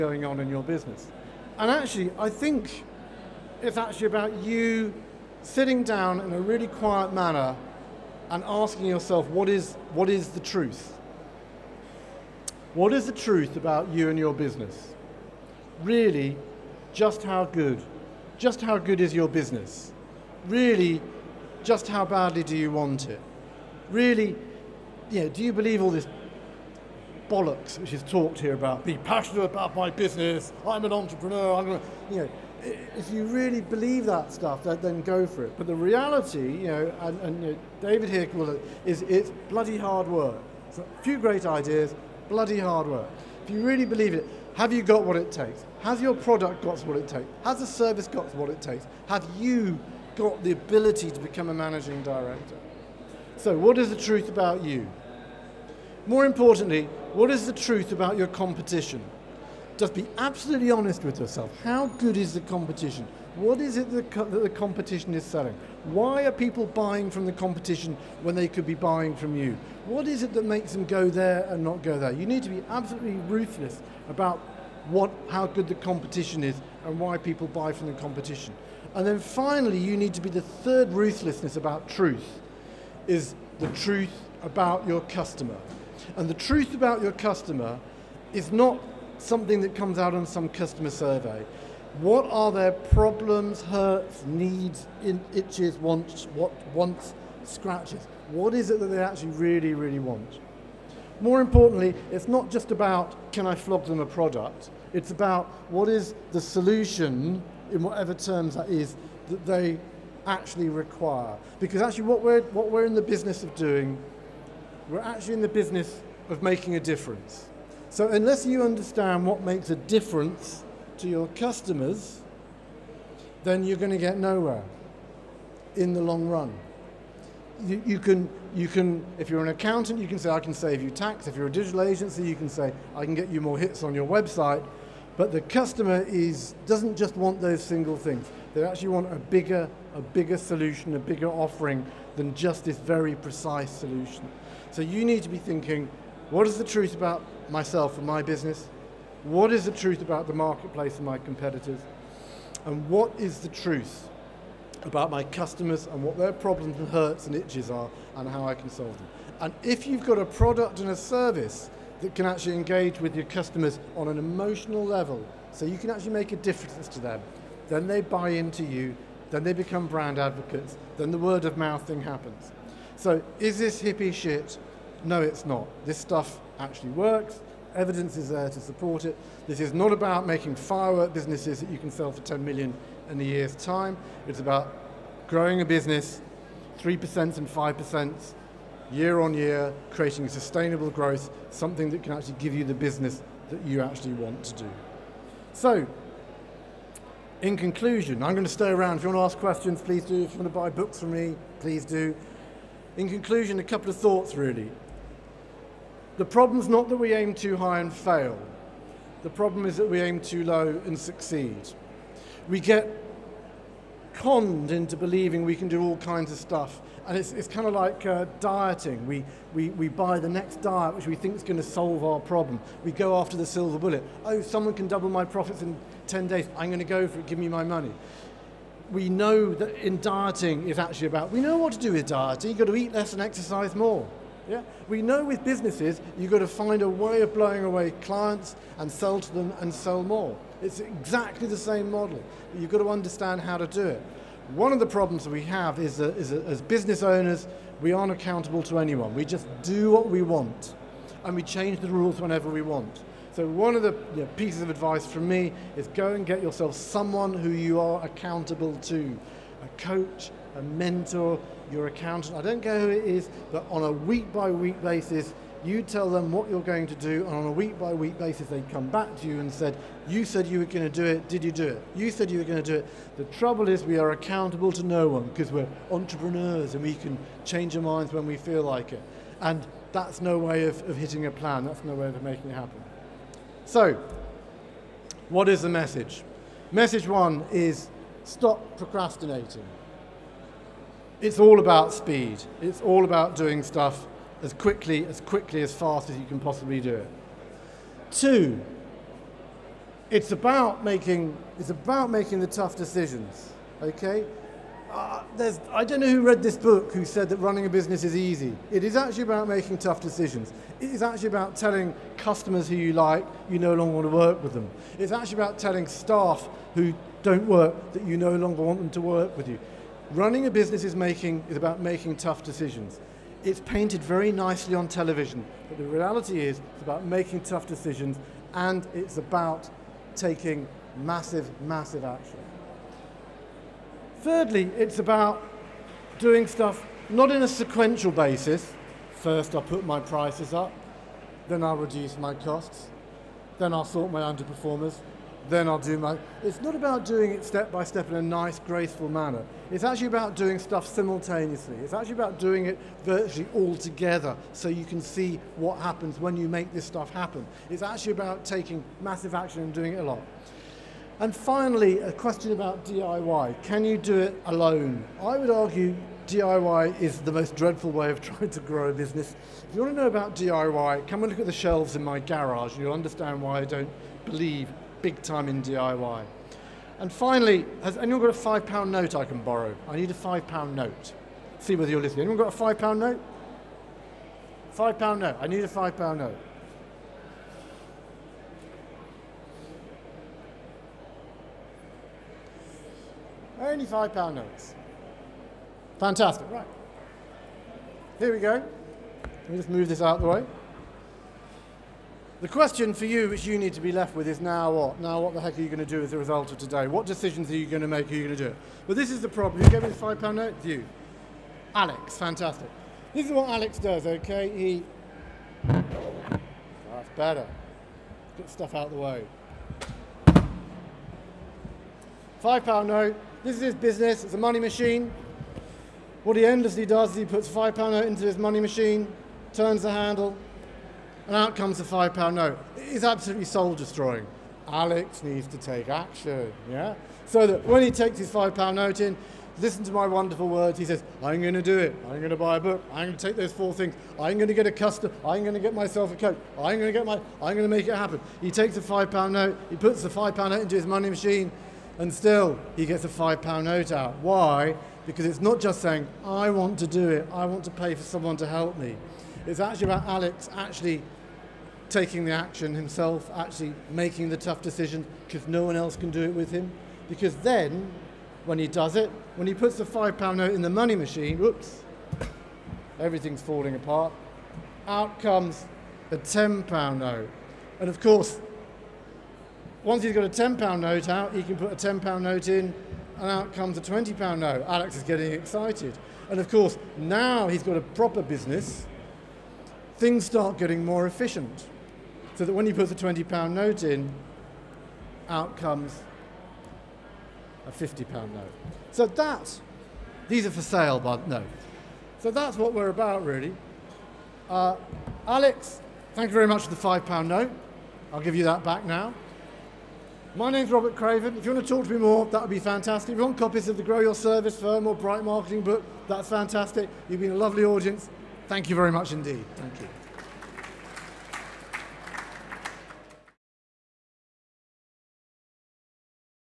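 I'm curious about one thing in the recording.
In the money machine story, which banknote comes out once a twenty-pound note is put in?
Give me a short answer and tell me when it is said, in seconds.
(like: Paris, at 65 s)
£50 note, at 497 s.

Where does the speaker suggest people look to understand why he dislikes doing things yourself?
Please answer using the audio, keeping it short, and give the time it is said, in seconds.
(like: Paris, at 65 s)
The shelves in my garage, at 371 s.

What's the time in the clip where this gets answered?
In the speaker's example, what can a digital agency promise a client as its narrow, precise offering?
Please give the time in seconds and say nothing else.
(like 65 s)
133 s.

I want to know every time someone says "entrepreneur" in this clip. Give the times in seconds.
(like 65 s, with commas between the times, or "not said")
30 s, 275 s.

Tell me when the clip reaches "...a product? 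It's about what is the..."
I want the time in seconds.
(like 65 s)
103 s.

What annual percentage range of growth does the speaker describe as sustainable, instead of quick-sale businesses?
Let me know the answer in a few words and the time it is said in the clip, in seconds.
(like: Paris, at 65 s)
3% and 5%, at 186 s.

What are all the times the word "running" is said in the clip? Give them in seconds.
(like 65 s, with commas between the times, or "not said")
307 s, 320 s.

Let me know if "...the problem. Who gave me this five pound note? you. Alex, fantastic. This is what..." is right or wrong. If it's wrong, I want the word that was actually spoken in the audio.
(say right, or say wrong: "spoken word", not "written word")
right.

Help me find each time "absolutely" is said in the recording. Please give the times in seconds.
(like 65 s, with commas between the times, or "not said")
60 s, 72 s, 433 s.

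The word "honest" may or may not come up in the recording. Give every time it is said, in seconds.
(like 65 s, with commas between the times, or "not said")
60 s.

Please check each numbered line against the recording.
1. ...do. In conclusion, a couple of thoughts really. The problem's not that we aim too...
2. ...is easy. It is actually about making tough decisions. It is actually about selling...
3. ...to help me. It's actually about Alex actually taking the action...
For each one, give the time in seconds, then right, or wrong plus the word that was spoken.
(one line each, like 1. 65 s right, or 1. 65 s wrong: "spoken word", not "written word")
1. 201 s right
2. 308 s wrong: "telling", not "selling"
3. 458 s right.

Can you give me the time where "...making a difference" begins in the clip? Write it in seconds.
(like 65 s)
116 s.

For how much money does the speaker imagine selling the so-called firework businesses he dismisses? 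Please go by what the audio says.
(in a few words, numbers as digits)
10 million.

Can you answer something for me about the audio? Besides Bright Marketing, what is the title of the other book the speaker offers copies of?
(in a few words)
Grow Your Service Firm.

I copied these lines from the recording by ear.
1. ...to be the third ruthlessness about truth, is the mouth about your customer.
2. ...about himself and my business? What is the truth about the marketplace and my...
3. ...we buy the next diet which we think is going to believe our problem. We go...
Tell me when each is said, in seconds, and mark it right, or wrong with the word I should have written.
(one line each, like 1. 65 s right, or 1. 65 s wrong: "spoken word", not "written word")
1. 80 s wrong: "truth", not "mouth"
2. 146 s wrong: "myself", not "himself"
3. 219 s wrong: "solve", not "believe".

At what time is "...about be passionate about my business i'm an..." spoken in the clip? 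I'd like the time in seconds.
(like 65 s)
28 s.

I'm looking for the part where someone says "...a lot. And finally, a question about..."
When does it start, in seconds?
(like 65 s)
359 s.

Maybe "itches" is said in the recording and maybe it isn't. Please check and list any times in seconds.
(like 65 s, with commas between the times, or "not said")
95 s, 157 s.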